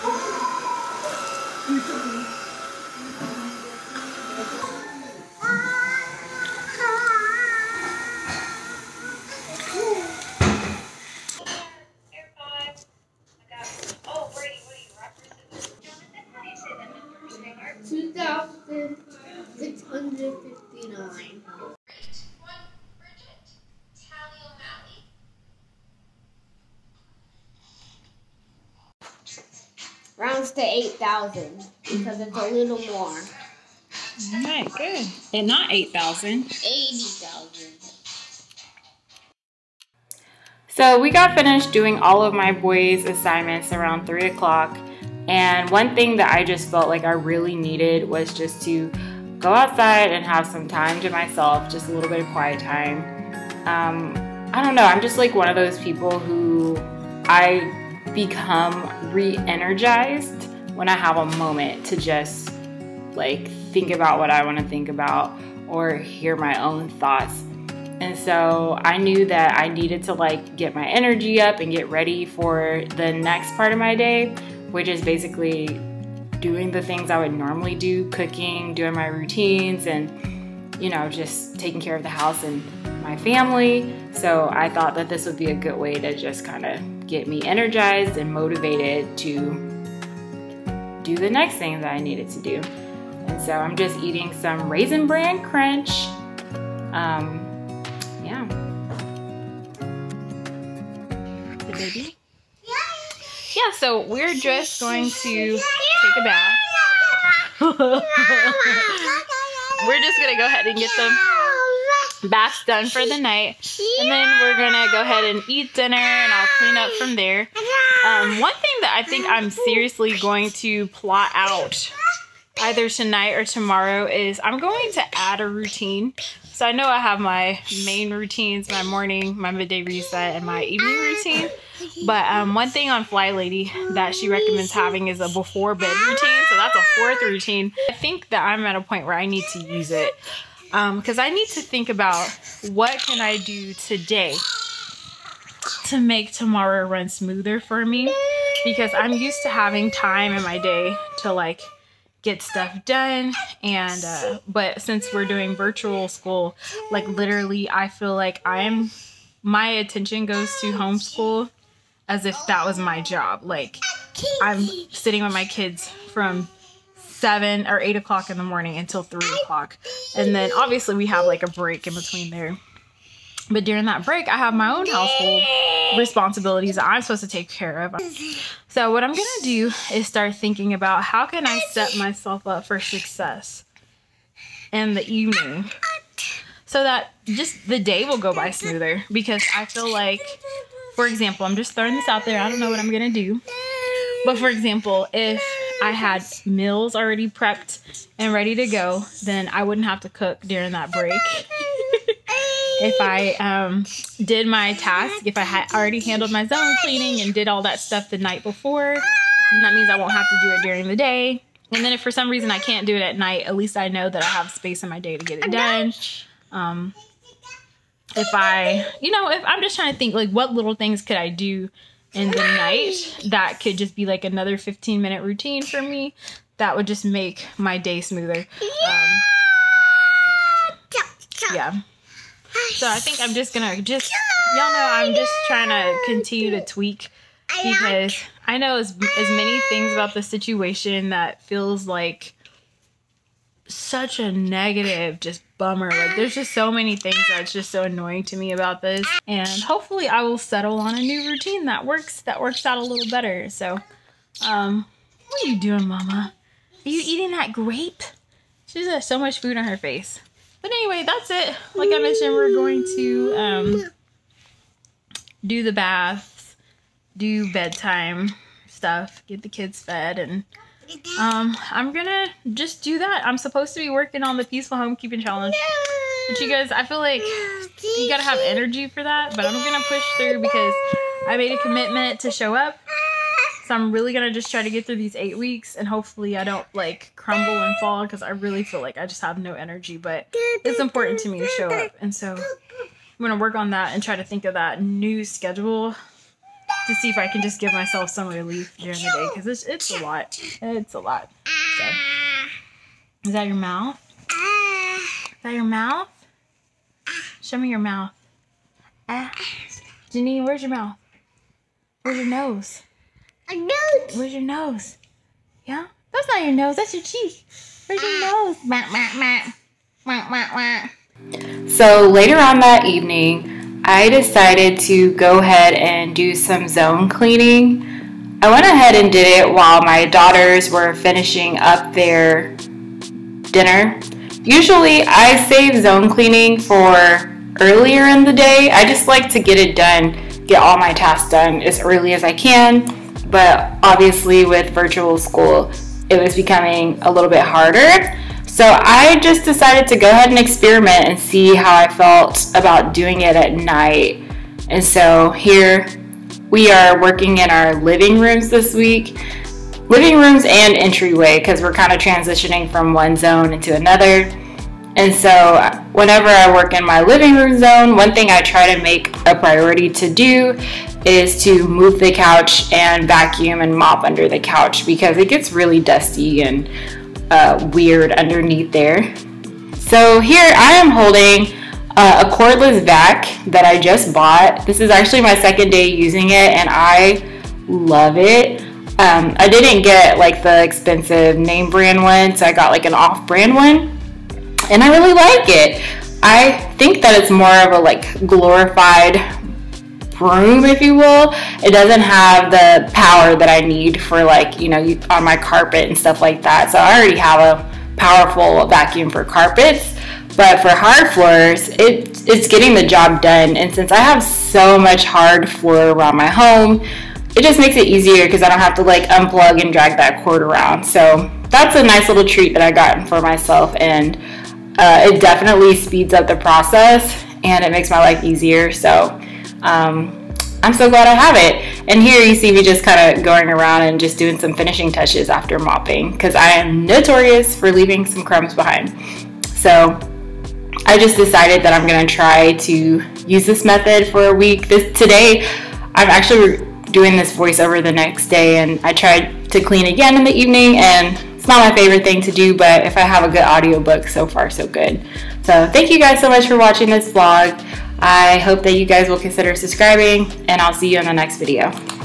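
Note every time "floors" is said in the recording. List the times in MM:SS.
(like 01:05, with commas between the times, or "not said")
06:51, 06:55.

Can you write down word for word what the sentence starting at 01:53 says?
And then we're going to go ahead and eat dinner and I'll clean up from there.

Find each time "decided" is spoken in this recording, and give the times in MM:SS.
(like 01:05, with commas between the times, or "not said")
05:24, 05:49, 07:21.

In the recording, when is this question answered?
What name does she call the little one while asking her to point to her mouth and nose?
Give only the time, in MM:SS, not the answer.
05:10.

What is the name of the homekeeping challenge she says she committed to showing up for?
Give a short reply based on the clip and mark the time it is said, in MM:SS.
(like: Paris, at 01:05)
peaceful homekeeping challenge, at 04:34.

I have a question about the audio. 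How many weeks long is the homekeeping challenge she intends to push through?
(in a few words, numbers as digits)
8.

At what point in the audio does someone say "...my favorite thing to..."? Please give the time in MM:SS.
07:31.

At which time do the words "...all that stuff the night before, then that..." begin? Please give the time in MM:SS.
03:27.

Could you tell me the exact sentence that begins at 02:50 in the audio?
And then obviously we have like a break in between there.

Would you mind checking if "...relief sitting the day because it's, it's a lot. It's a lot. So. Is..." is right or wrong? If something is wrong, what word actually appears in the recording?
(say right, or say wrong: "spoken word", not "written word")
wrong: "during", not "sitting".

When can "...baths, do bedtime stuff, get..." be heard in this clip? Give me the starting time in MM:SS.
04:25.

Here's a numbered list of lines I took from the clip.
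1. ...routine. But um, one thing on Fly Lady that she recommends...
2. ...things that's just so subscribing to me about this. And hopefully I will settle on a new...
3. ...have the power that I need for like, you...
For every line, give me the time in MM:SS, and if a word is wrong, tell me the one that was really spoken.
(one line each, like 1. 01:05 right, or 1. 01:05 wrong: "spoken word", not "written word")
1. 02:10 right
2. 04:06 wrong: "annoying", not "subscribing"
3. 06:42 right.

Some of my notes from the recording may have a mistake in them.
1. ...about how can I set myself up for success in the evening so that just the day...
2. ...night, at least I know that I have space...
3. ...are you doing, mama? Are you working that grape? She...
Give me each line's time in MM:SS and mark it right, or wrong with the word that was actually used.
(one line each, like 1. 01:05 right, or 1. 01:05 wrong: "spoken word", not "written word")
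1. 03:00 right
2. 03:33 right
3. 04:15 wrong: "eating", not "working".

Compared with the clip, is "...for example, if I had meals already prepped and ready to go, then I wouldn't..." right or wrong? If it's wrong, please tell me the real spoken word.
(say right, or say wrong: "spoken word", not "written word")
right.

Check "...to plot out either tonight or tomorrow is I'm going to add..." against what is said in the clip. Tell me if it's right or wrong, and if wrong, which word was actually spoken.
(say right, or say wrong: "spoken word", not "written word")
right.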